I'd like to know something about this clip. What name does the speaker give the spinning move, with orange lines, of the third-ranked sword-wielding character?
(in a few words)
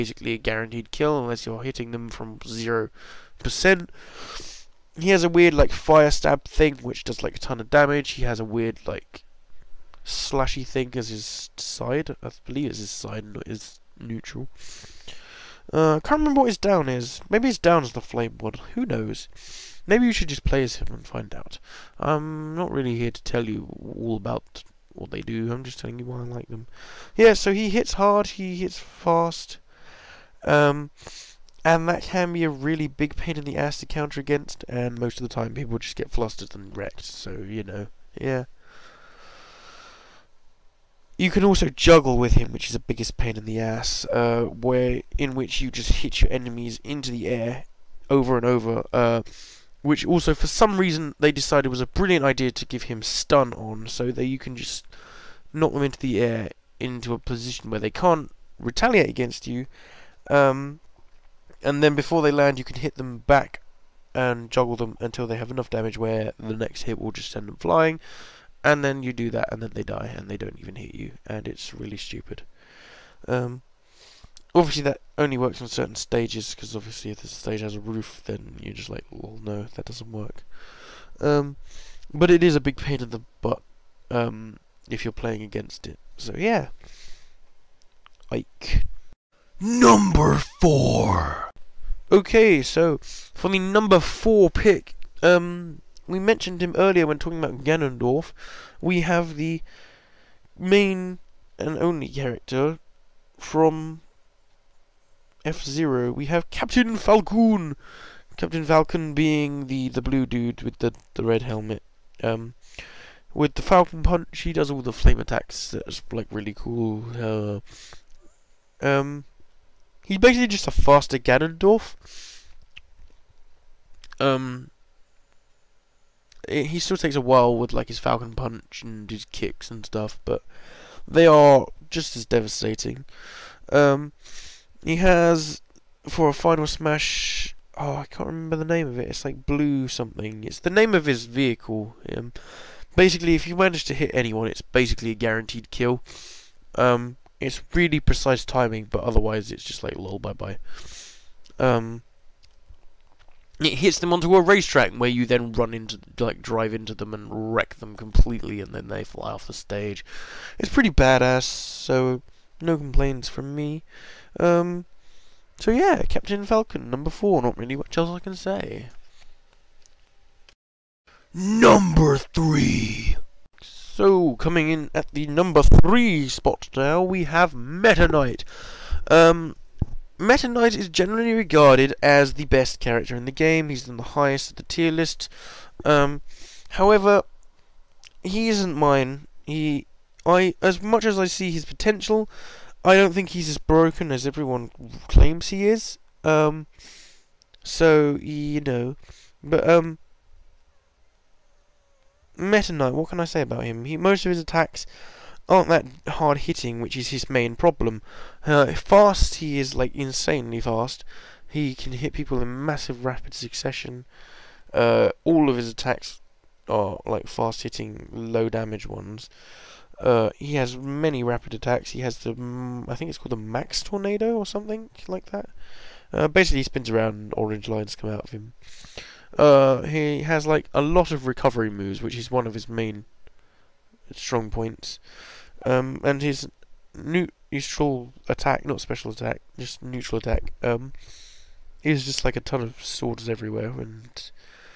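Mach Tornado.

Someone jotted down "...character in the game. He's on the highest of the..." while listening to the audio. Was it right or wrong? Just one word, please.
right.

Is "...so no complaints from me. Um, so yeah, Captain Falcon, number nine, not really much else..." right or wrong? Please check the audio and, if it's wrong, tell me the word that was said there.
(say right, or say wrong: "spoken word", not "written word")
wrong: "four", not "nine".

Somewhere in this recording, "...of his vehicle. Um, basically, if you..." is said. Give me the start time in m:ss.
2:20.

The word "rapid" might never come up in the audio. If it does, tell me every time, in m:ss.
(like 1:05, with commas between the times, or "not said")
3:33, 3:41.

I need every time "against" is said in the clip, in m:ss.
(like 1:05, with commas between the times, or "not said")
0:34, 0:59, 1:25.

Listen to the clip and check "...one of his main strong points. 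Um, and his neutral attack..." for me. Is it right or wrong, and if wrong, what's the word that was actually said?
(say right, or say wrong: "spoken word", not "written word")
right.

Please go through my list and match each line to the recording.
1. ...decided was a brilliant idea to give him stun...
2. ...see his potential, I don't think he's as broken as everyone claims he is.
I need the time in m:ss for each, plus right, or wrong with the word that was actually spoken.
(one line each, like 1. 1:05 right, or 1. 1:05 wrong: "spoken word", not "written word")
1. 0:51 right
2. 3:11 right.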